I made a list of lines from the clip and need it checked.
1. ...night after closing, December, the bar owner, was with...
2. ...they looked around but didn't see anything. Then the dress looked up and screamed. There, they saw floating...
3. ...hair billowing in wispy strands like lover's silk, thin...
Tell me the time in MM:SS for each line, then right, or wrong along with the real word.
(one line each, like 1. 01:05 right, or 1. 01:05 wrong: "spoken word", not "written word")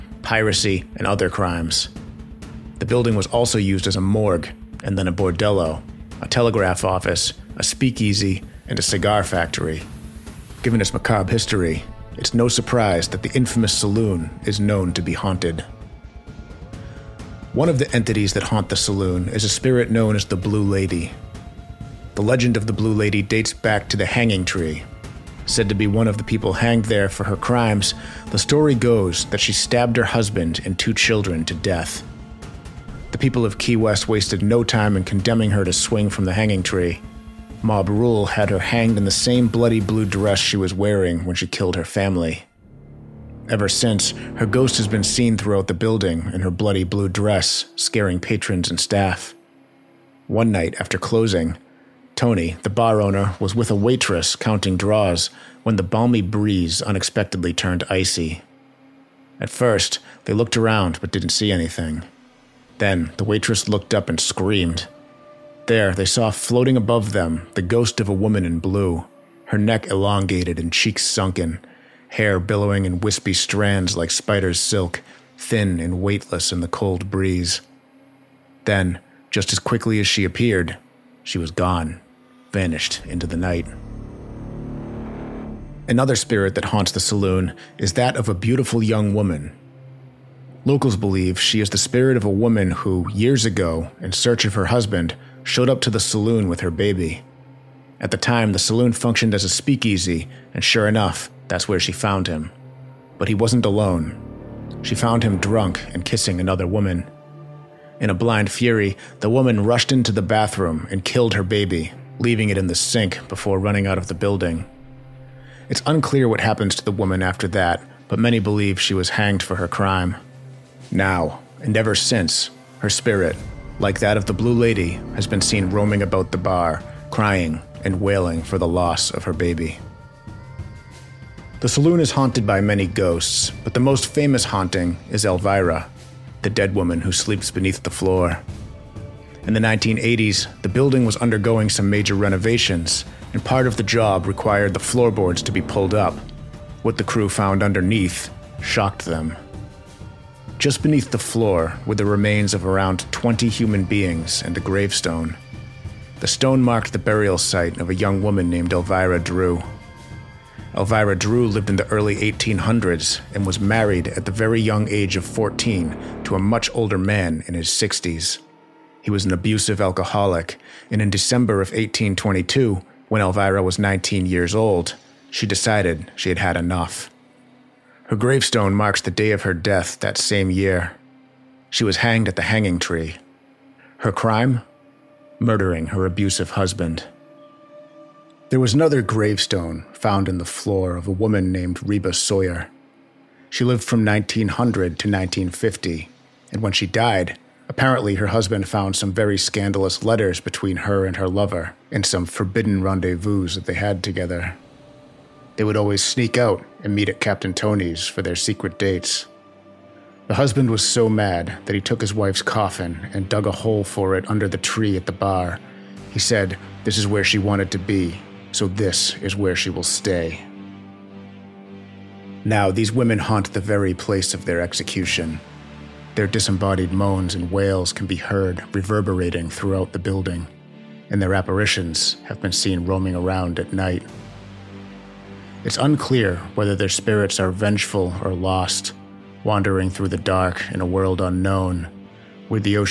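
1. 00:50 wrong: "Tony", not "December"
2. 01:00 wrong: "waitress", not "dress"
3. 01:12 wrong: "spider", not "lover".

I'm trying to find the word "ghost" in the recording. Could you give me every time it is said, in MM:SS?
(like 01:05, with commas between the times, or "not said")
00:44, 01:07, 02:12.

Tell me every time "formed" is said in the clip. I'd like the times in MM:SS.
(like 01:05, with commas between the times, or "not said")
not said.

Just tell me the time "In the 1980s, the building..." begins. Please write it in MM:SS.
02:19.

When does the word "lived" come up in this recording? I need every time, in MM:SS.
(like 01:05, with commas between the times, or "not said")
02:41, 03:13.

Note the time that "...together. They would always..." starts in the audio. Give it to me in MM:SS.
03:24.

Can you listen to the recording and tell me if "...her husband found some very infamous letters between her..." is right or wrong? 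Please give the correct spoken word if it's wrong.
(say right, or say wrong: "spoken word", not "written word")
wrong: "scandalous", not "infamous".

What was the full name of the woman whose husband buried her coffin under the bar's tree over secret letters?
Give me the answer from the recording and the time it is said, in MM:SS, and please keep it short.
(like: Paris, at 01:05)
Reba Sawyer, at 03:11.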